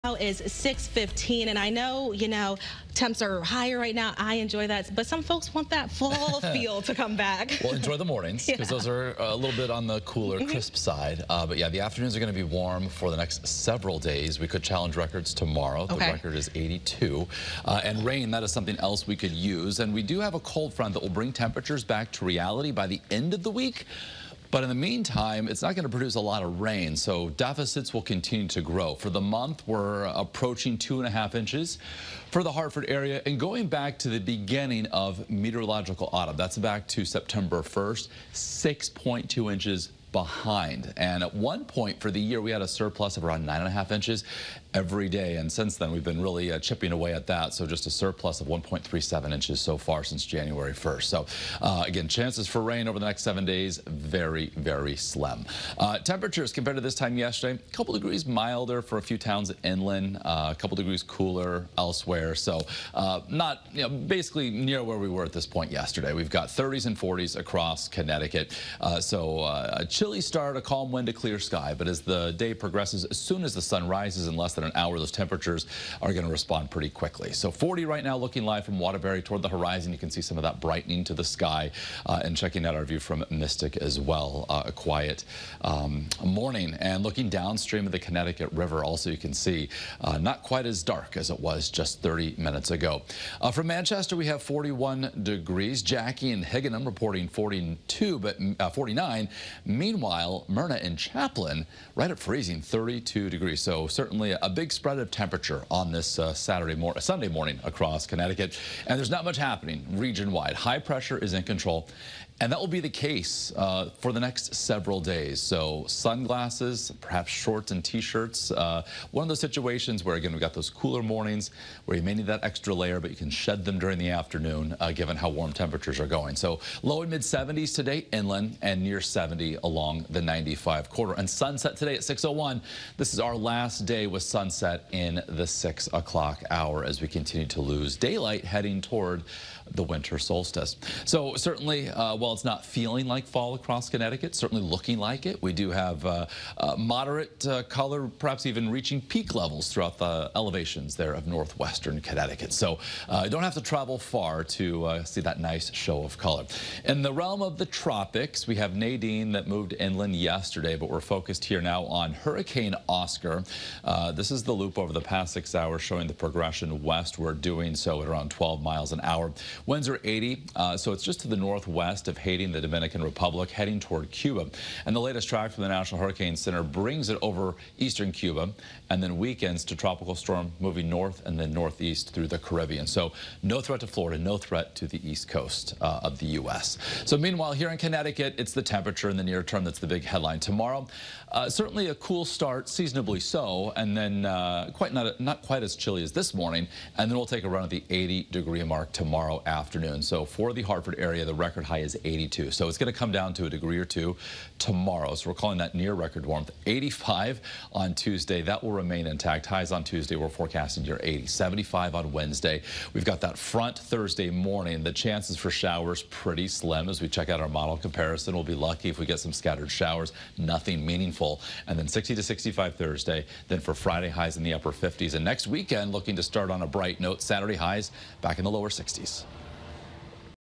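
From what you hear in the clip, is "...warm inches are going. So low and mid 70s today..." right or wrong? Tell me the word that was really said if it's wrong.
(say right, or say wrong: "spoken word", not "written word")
wrong: "temperatures", not "inches".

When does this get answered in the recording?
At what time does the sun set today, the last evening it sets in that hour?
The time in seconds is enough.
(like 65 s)
132 s.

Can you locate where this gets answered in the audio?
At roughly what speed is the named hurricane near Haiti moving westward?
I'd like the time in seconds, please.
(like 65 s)
168 s.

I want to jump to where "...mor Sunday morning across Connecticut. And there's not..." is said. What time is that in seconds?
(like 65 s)
106 s.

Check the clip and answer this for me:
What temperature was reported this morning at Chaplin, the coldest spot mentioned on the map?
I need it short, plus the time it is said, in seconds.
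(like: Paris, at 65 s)
32 degrees, at 102 s.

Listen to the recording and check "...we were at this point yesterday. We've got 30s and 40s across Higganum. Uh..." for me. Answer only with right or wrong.
wrong.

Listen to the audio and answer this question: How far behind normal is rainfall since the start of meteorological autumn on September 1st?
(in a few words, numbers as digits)
6.2 inches.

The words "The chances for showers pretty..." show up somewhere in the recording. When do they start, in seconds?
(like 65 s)
214 s.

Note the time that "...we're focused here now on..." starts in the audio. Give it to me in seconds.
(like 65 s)
160 s.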